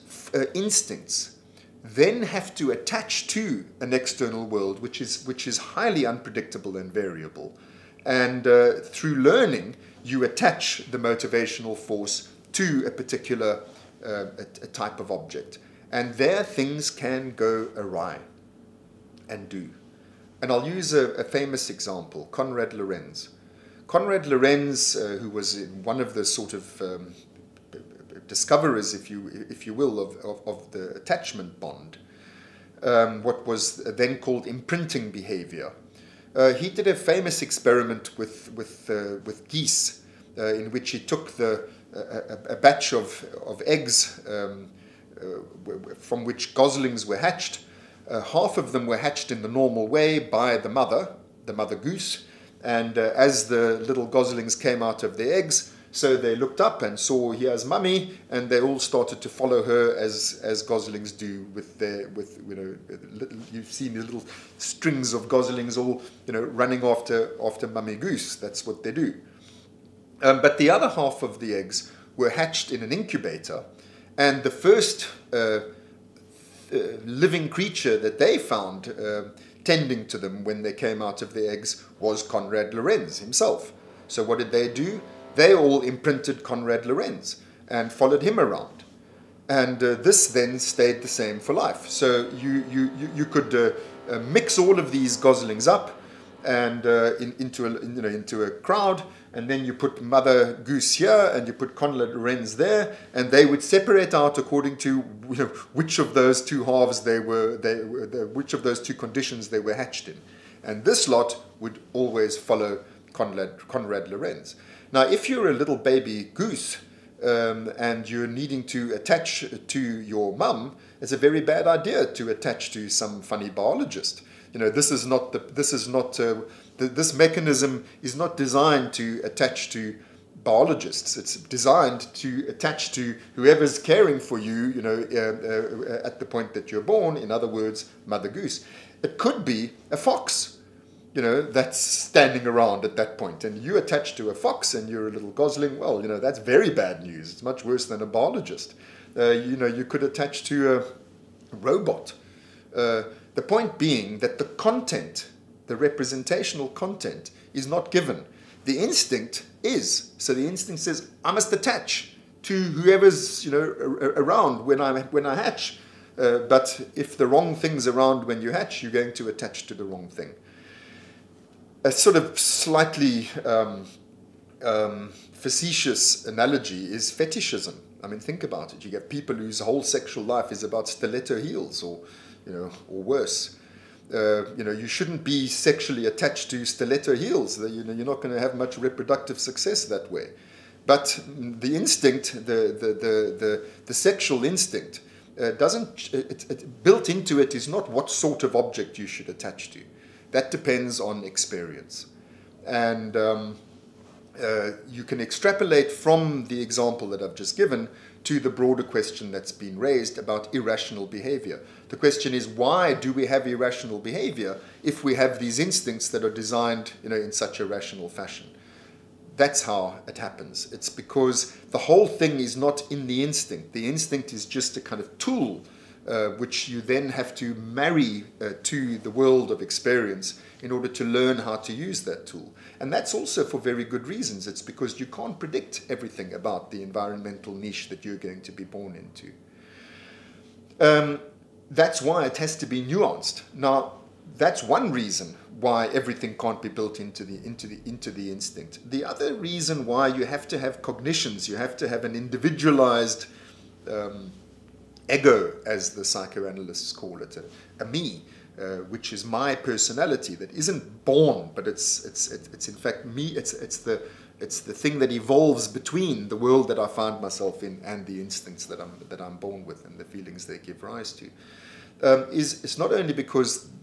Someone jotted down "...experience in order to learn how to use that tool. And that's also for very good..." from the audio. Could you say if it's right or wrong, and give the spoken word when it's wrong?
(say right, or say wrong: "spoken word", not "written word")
right.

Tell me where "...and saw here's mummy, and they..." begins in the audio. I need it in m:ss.
0:56.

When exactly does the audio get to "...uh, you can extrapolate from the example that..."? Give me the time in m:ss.
3:24.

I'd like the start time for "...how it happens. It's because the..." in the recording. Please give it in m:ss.
3:39.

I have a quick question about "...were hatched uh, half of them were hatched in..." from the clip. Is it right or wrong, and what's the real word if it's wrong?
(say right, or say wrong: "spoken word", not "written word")
right.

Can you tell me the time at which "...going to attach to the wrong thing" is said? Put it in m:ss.
2:48.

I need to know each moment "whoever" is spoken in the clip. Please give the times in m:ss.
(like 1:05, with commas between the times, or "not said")
2:13, 2:42.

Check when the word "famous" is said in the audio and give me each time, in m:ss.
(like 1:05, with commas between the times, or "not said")
0:21, 0:36.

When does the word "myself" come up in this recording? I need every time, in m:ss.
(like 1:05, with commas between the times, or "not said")
4:27.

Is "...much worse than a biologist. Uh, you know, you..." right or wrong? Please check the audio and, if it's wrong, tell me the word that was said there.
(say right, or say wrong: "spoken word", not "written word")
right.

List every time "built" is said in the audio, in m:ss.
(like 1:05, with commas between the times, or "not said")
3:16, 4:06.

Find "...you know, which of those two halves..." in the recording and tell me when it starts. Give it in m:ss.
1:45.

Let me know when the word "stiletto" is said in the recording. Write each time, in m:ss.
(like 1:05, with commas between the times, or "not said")
3:00, 3:06.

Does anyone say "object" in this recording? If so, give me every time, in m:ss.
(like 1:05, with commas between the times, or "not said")
0:15, 3:18.